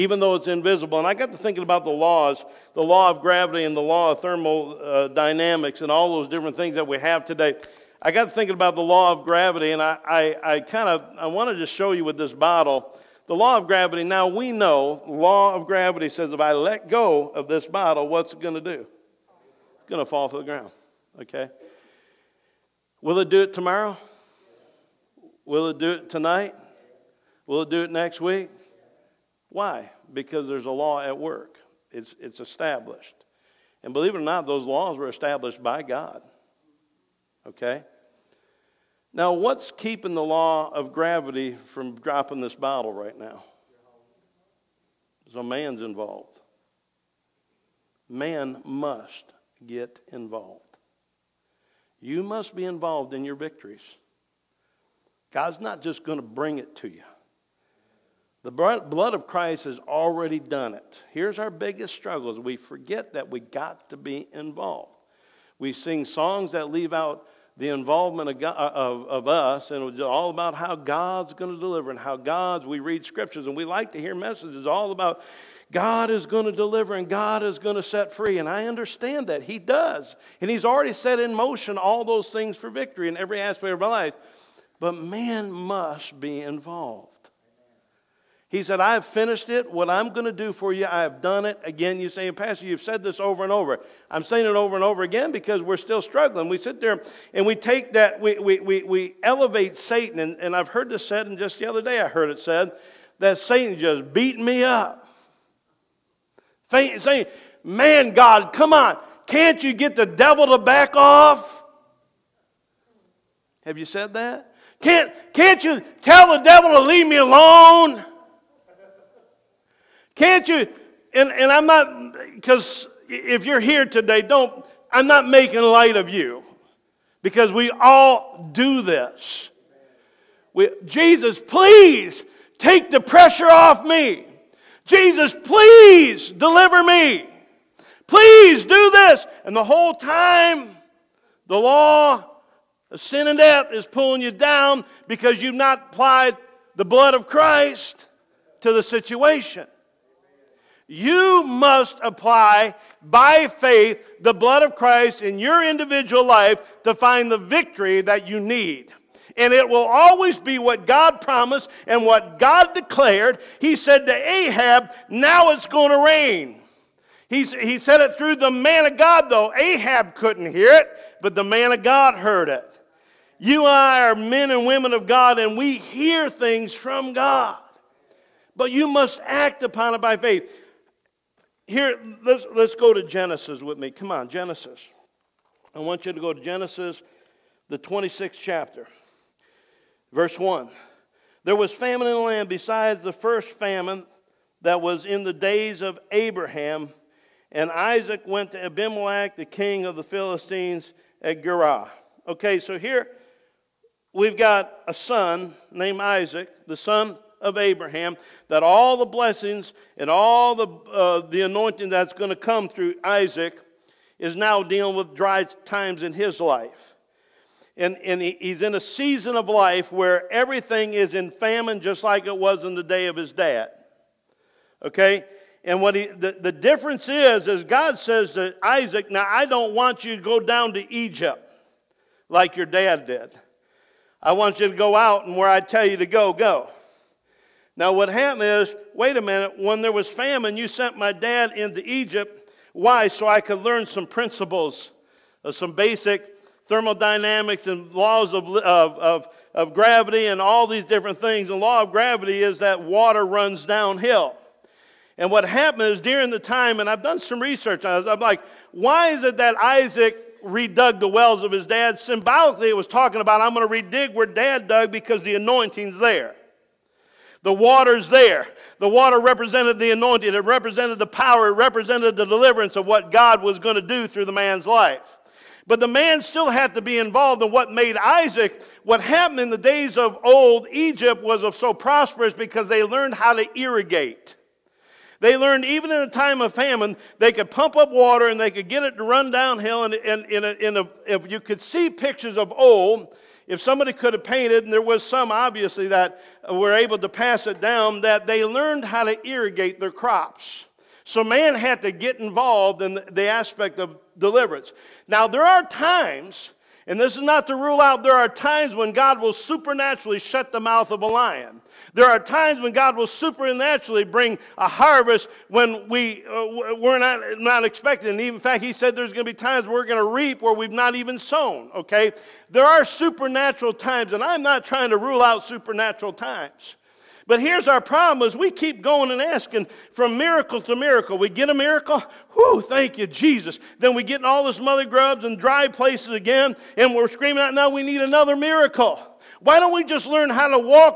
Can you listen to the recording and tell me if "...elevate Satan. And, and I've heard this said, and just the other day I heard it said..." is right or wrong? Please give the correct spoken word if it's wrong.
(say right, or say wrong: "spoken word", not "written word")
right.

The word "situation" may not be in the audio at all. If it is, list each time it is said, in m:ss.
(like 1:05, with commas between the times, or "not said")
2:28.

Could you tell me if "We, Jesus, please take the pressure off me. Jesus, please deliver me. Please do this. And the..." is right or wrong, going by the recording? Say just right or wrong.
right.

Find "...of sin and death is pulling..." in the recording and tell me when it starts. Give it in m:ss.
2:22.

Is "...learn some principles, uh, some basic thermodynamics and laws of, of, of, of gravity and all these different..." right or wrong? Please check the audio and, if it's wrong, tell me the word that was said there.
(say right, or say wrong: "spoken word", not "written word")
right.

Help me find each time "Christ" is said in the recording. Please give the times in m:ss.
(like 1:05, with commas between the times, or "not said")
0:59, 2:27, 2:34.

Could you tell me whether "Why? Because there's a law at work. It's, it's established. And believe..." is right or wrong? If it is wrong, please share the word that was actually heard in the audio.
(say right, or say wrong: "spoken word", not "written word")
right.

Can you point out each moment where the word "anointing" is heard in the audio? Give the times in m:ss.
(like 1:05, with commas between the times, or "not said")
3:31, 4:25, 4:29.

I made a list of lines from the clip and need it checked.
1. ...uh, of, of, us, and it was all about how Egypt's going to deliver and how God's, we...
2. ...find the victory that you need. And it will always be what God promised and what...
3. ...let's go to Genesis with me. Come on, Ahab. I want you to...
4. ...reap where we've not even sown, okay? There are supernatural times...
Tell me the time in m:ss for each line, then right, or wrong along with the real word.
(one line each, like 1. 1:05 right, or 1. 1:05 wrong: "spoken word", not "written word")
1. 1:08 wrong: "God", not "Egypt"
2. 2:36 right
3. 3:02 wrong: "Genesis", not "Ahab"
4. 5:20 right.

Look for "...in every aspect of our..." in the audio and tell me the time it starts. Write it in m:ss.
1:23.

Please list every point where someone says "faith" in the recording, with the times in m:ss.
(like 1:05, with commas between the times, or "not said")
2:33, 3:00.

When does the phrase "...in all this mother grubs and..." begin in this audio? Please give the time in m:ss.
5:34.